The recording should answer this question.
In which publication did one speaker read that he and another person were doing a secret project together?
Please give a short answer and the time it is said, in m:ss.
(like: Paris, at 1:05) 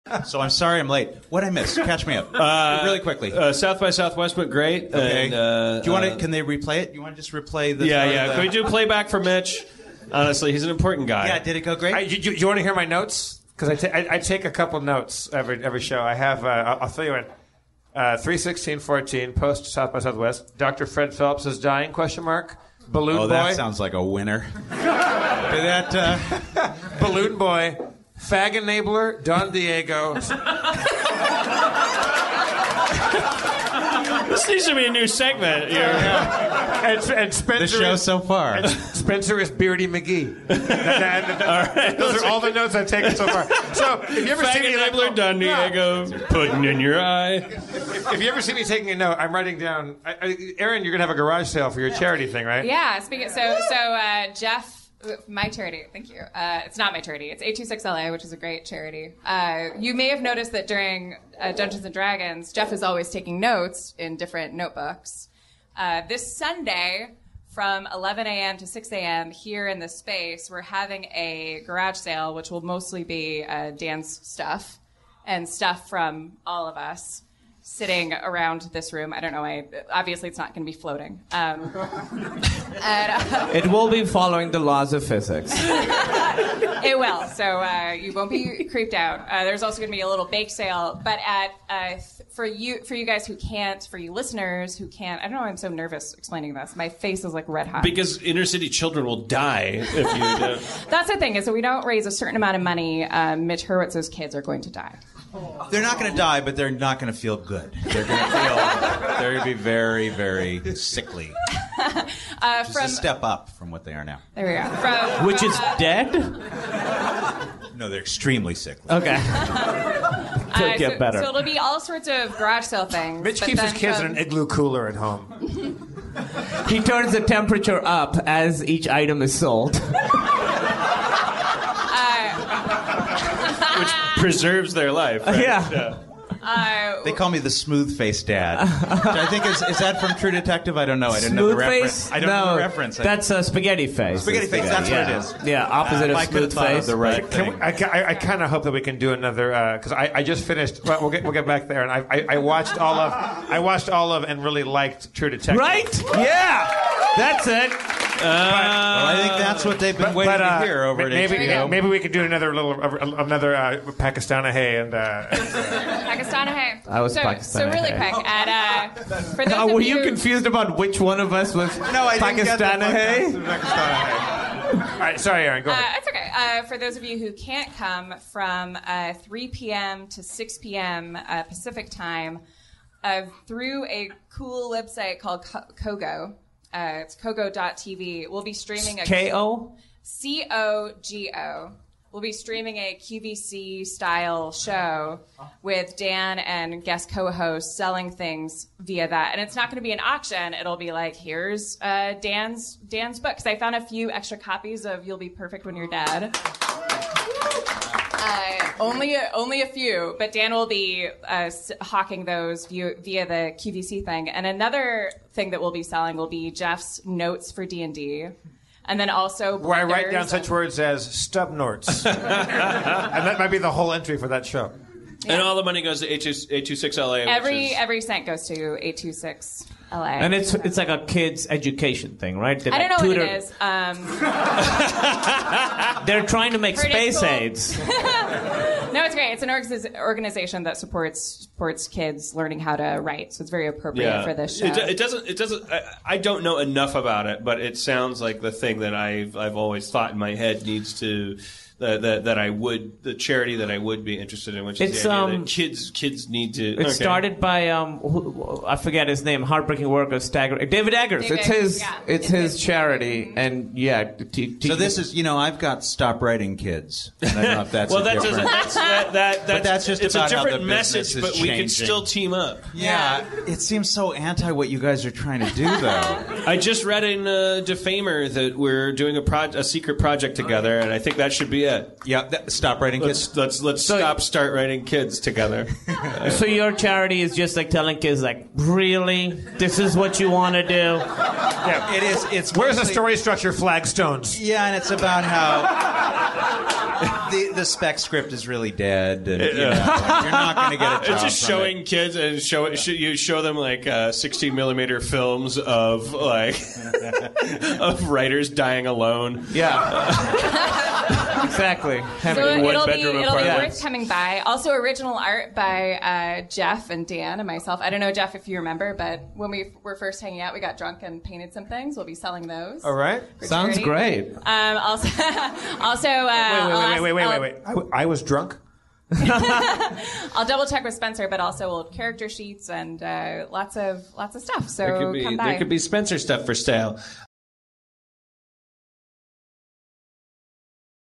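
Defamer, at 4:37.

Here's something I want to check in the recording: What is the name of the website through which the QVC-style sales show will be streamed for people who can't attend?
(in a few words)
Kogo.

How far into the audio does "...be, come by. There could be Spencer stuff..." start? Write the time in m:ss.
5:35.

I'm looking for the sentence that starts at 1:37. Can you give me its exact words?
Because inner city children will die if you.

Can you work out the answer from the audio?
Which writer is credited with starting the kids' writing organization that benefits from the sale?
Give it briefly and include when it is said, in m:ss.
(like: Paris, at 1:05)
David Eggers, at 4:20.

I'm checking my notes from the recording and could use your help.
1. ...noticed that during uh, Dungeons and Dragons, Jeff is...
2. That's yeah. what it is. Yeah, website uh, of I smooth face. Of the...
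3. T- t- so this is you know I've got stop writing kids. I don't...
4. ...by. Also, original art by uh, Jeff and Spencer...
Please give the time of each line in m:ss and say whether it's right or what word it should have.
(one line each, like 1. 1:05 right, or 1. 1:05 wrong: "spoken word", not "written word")
1. 1:00 right
2. 2:24 wrong: "opposite", not "website"
3. 4:24 right
4. 5:14 wrong: "Dan", not "Spencer".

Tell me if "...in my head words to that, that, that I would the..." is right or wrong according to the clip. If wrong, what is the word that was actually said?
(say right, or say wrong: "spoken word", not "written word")
wrong: "needs", not "words".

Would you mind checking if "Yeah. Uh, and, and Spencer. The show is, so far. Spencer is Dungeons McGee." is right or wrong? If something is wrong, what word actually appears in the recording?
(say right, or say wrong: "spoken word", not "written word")
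wrong: "Beardy", not "Dungeons".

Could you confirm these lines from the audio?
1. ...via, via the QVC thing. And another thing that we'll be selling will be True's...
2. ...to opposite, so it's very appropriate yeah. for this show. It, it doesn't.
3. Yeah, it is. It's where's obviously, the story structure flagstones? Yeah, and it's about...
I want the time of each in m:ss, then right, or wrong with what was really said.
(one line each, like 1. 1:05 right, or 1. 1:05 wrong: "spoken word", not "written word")
1. 3:32 wrong: "Jeff", not "True"
2. 4:02 wrong: "write", not "opposite"
3. 4:50 wrong: "mostly", not "obviously".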